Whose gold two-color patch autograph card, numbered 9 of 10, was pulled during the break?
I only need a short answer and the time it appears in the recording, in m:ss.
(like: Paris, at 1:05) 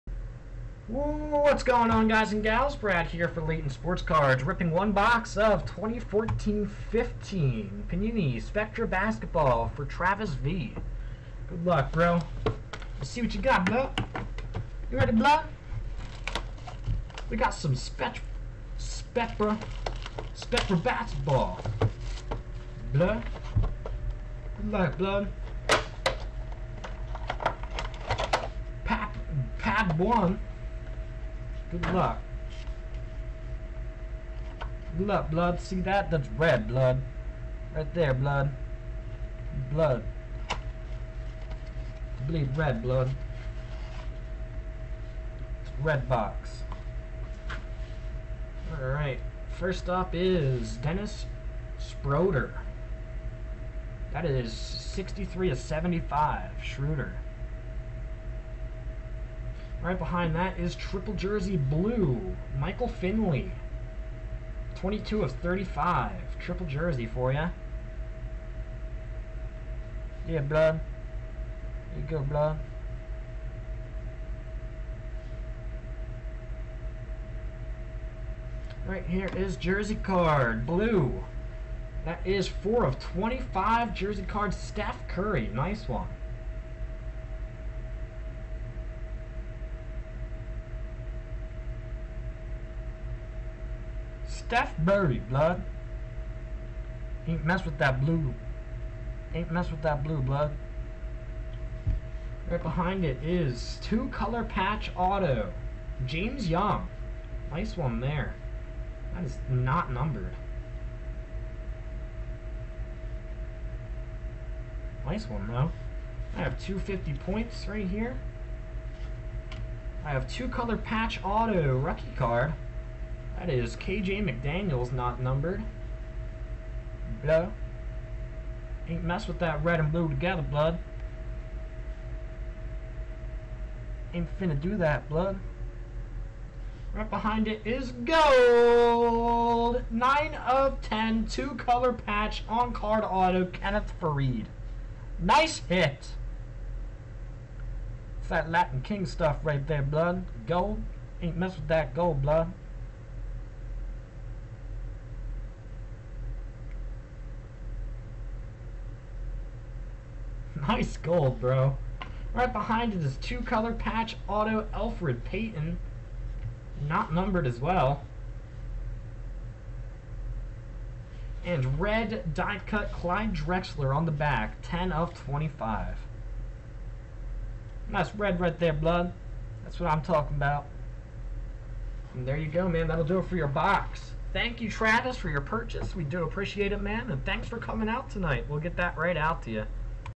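Kenneth Faried, at 2:23.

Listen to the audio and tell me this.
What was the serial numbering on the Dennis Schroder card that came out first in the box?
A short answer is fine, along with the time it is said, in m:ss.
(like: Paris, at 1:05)
63 to 75, at 0:54.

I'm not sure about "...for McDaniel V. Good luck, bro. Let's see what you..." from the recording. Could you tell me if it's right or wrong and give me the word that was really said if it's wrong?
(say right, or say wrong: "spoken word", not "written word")
wrong: "Travis", not "McDaniel".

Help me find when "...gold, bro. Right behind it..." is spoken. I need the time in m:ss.
2:40.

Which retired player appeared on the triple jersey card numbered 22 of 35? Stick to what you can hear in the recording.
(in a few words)
Michael Finley.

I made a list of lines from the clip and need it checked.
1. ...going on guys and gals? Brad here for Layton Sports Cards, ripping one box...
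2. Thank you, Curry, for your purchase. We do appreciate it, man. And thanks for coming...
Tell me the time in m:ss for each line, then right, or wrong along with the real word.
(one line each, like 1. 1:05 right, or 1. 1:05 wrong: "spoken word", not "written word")
1. 0:01 right
2. 3:04 wrong: "Travis", not "Curry".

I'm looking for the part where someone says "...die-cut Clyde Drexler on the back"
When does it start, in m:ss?
2:52.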